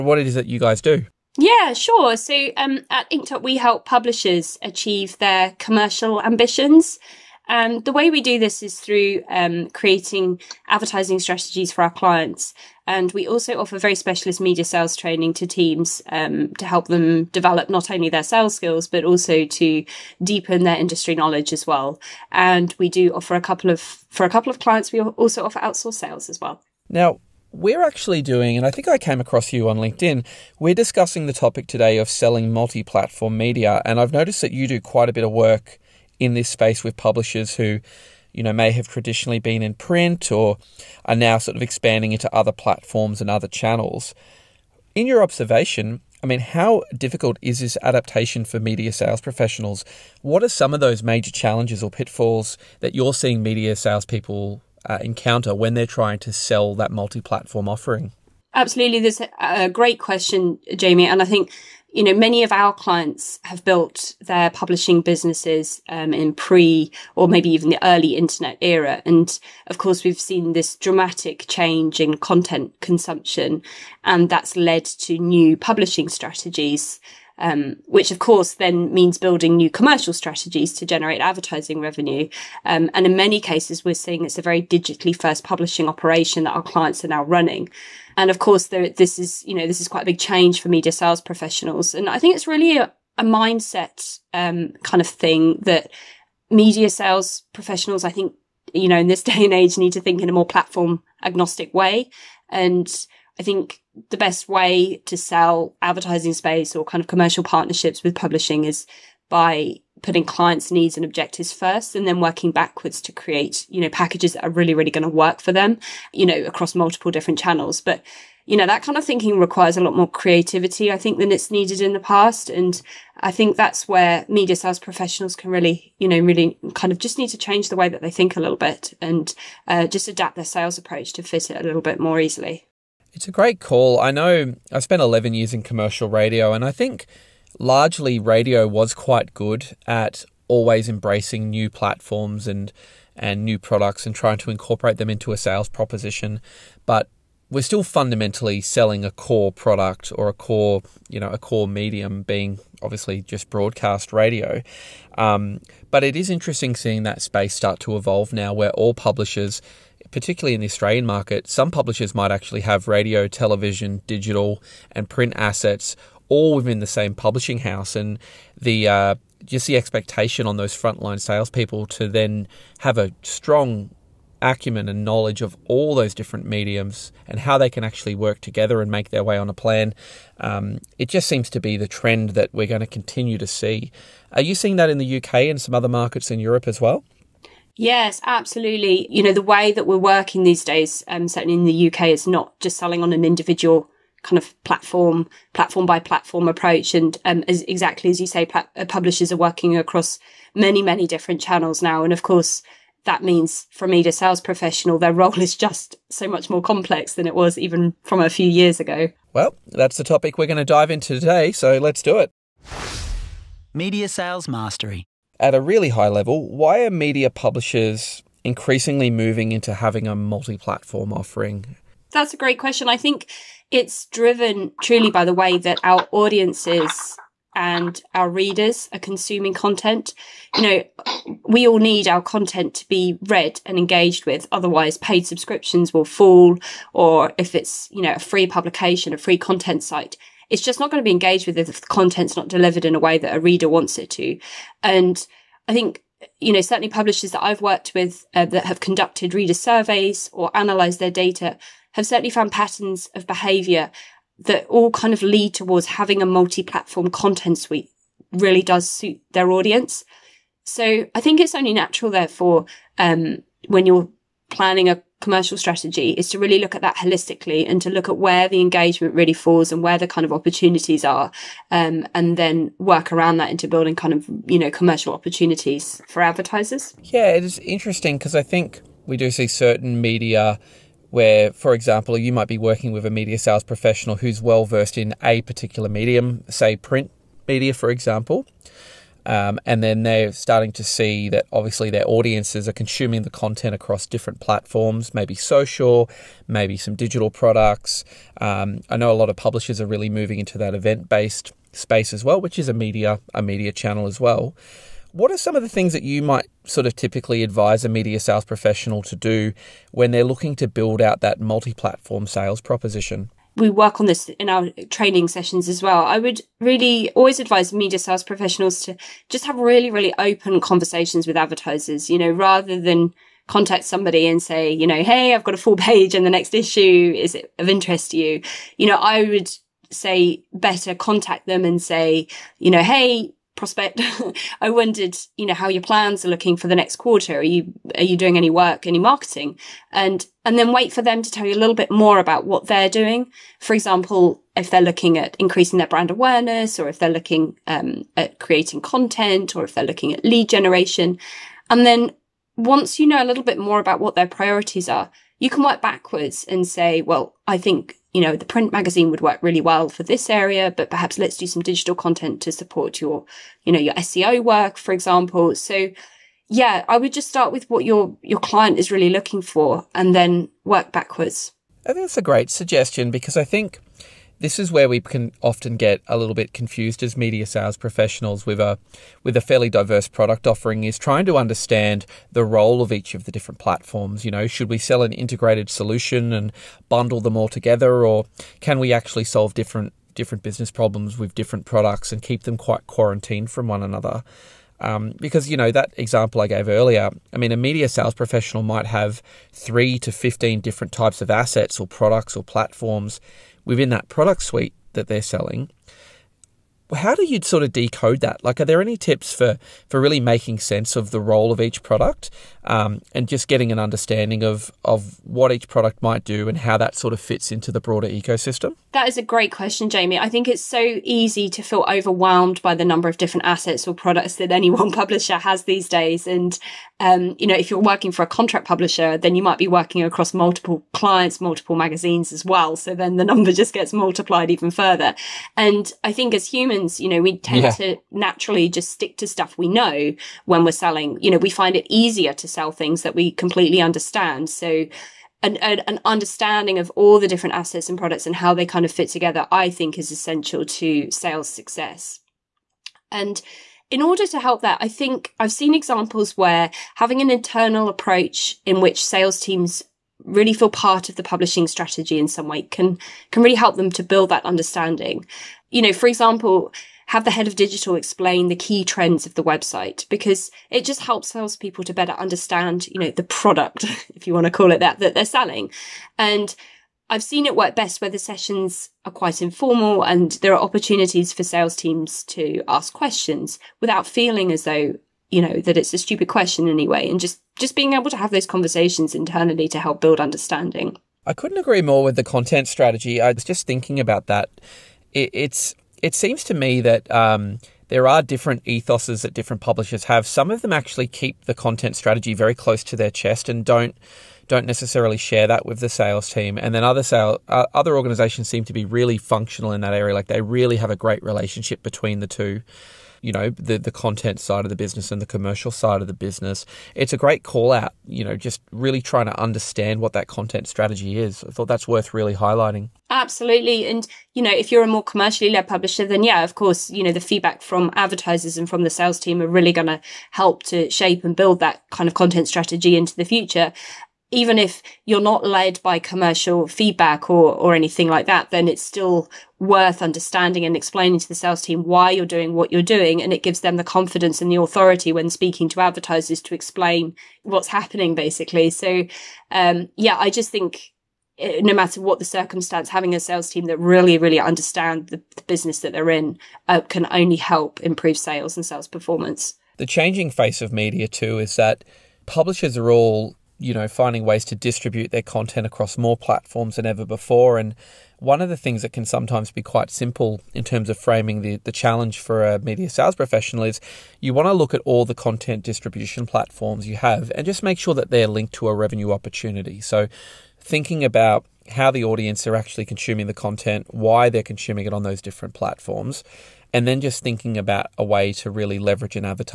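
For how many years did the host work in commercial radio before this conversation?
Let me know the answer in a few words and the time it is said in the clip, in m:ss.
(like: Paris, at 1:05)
11, at 2:15.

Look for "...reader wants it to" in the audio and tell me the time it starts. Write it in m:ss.
4:03.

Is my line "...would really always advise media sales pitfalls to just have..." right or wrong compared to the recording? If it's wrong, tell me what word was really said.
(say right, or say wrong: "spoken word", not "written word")
wrong: "professionals", not "pitfalls".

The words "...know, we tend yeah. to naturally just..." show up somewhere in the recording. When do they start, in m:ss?
7:17.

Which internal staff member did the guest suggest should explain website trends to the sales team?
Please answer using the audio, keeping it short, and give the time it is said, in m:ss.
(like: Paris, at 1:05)
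Head of digital, at 7:47.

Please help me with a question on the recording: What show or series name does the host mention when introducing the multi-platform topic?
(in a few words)
Media Sales Mastery.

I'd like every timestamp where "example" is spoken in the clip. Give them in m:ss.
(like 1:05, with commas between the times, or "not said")
4:41, 4:47, 5:43, 6:04, 6:35, 7:35, 7:46.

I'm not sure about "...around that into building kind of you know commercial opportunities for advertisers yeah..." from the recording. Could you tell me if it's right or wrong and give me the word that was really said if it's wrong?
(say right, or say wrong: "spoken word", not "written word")
right.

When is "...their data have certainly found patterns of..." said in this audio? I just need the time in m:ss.
4:10.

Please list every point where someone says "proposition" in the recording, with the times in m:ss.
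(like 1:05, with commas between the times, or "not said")
2:25, 5:12.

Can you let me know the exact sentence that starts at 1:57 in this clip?
But, you know, that kind of thinking requires a lot more creativity, I think, than it's needed in the past.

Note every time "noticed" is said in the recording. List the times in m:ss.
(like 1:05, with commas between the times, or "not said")
0:34.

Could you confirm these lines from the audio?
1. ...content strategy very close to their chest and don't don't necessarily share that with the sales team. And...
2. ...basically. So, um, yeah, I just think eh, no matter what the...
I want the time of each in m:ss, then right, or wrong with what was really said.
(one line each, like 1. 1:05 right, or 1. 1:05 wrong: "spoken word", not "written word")
1. 8:21 right
2. 9:08 right.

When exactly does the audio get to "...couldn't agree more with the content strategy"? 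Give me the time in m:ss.
8:11.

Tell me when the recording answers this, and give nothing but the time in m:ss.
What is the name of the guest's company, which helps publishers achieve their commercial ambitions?
0:03.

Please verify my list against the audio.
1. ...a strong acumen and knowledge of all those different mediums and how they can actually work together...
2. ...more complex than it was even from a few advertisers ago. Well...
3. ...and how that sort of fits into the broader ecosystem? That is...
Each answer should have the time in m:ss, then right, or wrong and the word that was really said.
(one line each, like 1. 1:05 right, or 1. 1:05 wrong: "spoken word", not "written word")
1. 2:52 right
2. 3:26 wrong: "years", not "advertisers"
3. 6:56 right.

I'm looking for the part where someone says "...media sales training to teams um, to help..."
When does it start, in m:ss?
0:14.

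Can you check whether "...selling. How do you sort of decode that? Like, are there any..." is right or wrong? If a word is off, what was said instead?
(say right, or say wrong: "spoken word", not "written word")
right.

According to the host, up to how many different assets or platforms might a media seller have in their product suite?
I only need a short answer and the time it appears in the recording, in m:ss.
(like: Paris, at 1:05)
15, at 6:40.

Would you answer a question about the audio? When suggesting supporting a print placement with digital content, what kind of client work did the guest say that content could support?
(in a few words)
SEO.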